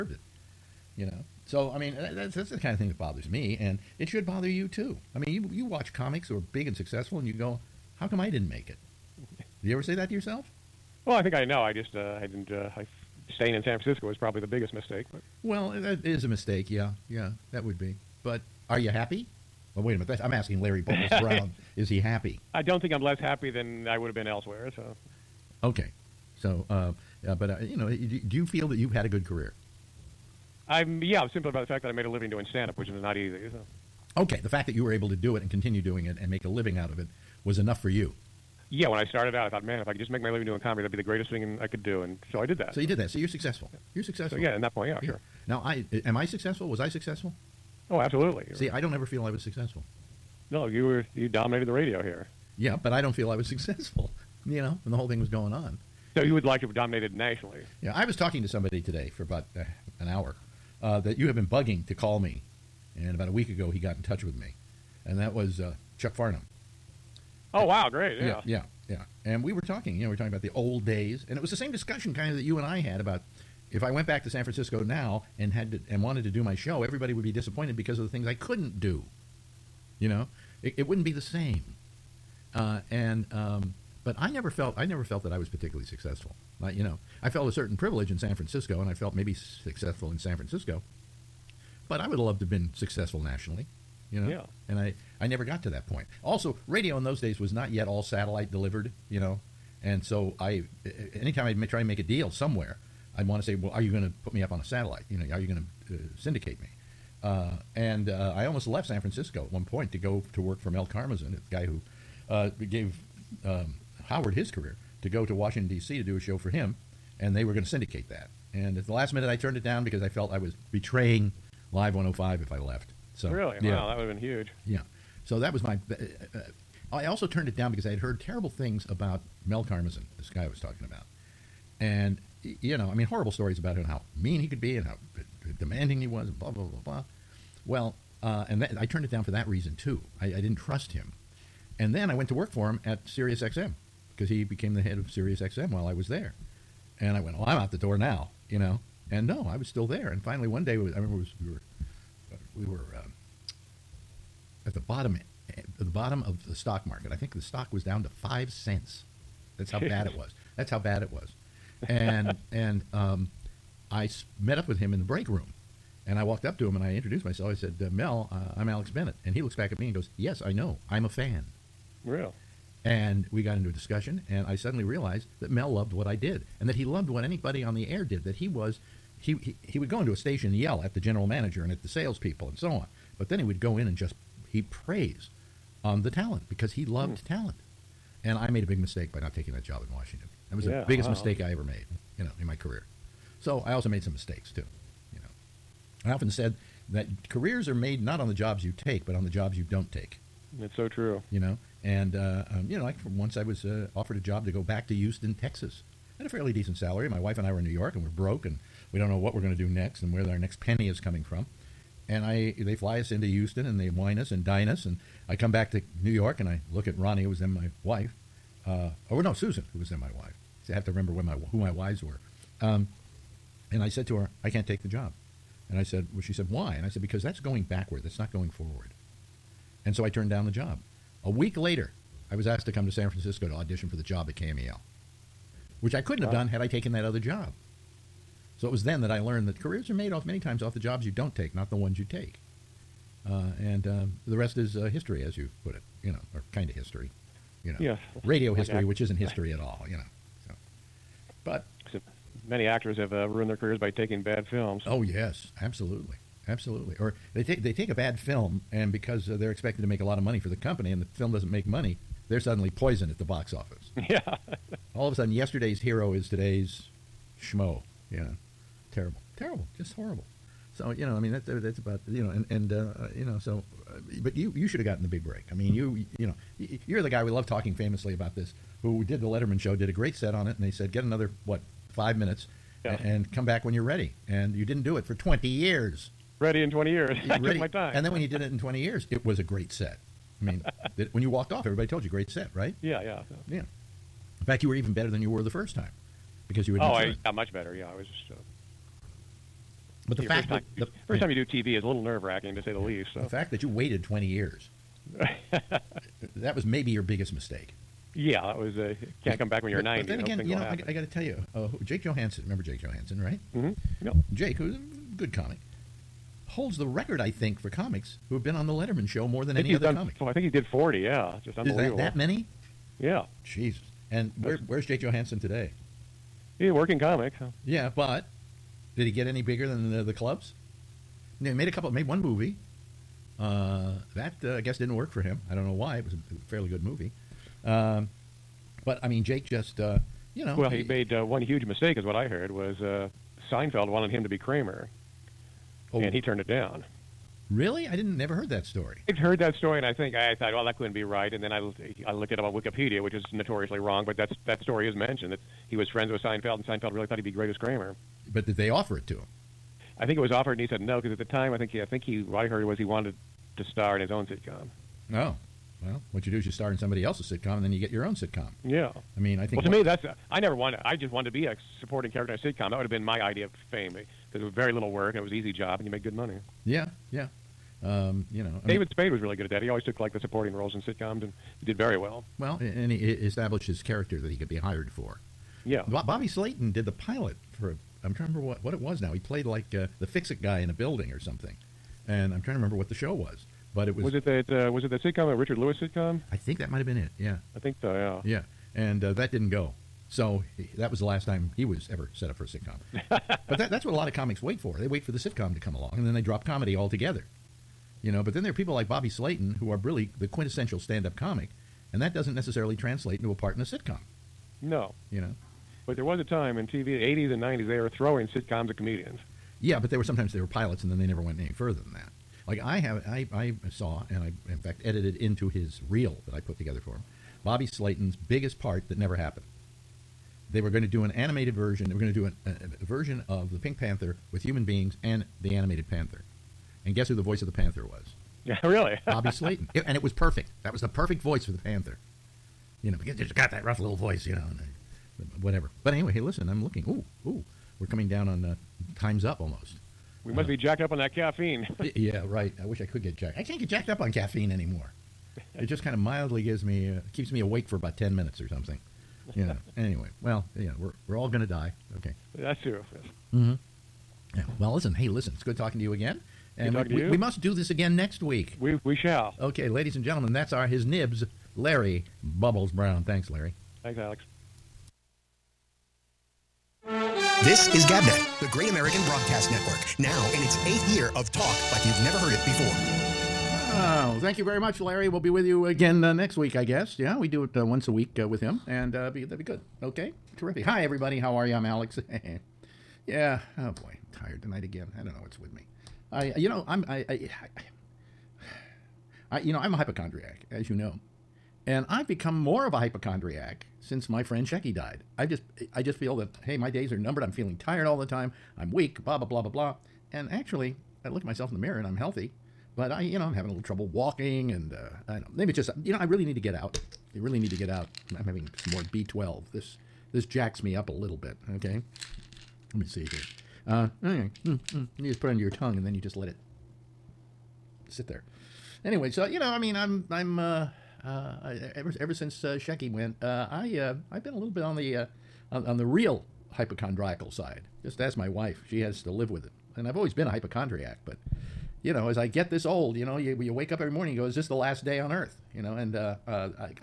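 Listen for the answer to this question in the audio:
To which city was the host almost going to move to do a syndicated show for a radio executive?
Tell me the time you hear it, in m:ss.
1:55.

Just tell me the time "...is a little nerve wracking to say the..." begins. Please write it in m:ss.
5:01.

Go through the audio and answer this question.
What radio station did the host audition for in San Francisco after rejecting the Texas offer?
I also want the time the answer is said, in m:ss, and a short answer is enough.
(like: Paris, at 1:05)
KMEL, at 3:54.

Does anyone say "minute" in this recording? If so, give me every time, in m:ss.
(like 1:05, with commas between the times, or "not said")
0:19, 1:59, 4:42, 7:38.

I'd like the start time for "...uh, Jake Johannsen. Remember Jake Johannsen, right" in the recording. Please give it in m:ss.
5:11.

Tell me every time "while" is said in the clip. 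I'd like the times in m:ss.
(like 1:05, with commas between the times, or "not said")
2:25.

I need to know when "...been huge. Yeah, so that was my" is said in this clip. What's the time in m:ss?
2:04.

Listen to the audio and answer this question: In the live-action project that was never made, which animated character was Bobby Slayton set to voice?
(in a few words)
the Pink Panther.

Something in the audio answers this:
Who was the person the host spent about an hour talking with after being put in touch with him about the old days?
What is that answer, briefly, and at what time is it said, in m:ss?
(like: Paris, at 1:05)
Chuck Farnham, at 1:05.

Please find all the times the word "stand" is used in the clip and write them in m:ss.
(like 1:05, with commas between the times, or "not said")
0:32, 6:50.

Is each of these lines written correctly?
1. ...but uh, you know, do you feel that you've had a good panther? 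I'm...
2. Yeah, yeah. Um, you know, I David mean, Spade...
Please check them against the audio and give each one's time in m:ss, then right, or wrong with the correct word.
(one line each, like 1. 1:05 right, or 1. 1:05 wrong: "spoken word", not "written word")
1. 0:27 wrong: "career", not "panther"
2. 6:16 right.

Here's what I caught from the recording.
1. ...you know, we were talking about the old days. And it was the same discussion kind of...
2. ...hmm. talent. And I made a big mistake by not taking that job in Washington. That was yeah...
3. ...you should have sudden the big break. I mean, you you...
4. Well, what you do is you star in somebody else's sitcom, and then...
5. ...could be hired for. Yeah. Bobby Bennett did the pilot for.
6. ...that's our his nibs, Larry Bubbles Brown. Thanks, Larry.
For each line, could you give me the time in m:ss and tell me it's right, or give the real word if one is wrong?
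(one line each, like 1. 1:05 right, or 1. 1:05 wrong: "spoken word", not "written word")
1. 1:09 right
2. 3:07 right
3. 4:34 wrong: "gotten", not "sudden"
4. 6:05 right
5. 6:24 wrong: "Slayton", not "Bennett"
6. 7:50 right.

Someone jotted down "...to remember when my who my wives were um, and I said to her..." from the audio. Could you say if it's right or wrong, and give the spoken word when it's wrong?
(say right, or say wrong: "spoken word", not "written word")
right.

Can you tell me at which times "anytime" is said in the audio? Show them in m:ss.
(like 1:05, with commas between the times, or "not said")
1:41.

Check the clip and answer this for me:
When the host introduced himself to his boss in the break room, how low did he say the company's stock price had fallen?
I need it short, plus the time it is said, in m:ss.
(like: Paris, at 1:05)
5 cents, at 2:38.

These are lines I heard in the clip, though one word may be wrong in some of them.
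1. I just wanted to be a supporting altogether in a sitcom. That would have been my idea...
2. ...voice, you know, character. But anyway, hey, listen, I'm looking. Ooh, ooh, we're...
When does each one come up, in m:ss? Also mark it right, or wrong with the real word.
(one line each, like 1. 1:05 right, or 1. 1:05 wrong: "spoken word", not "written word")
1. 6:10 wrong: "character", not "altogether"
2. 7:23 wrong: "whatever", not "character".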